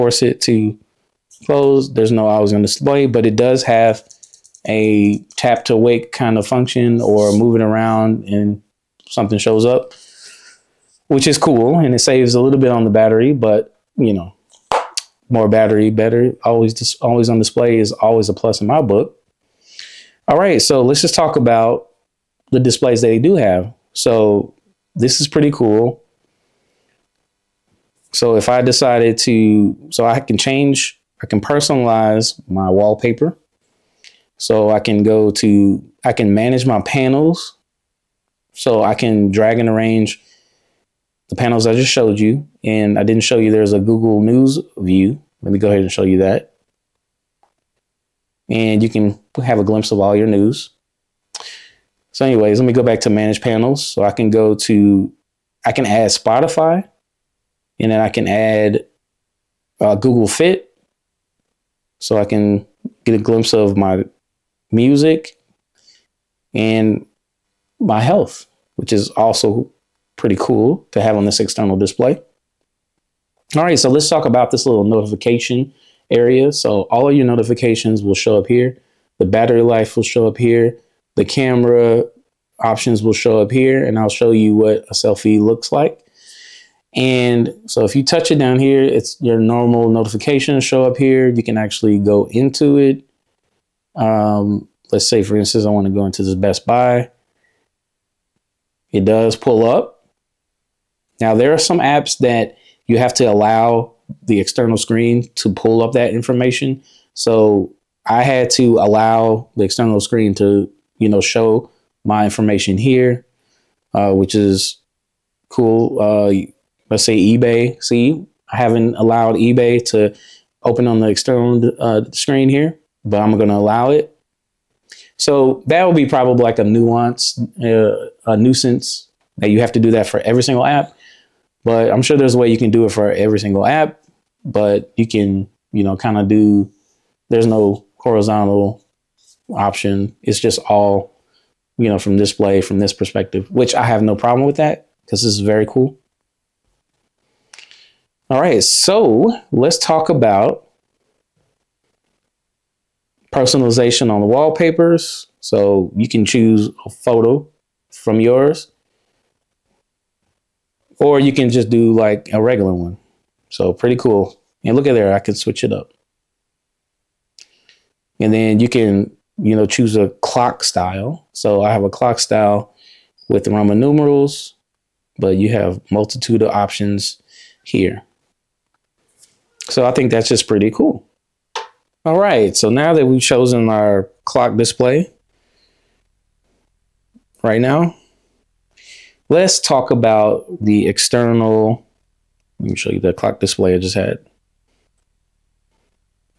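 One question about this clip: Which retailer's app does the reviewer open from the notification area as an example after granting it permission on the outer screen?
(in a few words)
Best Buy.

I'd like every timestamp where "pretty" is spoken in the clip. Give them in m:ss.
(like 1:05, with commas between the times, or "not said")
0:25, 1:10, 2:43, 3:00.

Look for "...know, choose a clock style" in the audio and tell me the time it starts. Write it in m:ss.
2:49.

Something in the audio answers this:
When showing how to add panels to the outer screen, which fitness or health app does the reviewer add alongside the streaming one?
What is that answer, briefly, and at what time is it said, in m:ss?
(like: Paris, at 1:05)
Google Fit, at 0:59.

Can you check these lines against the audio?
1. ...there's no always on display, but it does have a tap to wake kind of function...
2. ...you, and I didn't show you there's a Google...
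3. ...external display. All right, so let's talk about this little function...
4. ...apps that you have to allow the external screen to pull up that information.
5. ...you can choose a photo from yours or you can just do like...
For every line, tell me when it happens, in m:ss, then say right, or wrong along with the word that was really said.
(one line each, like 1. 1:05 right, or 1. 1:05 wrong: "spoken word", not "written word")
1. 0:01 right
2. 0:42 right
3. 1:11 wrong: "notification", not "function"
4. 1:41 right
5. 2:35 right.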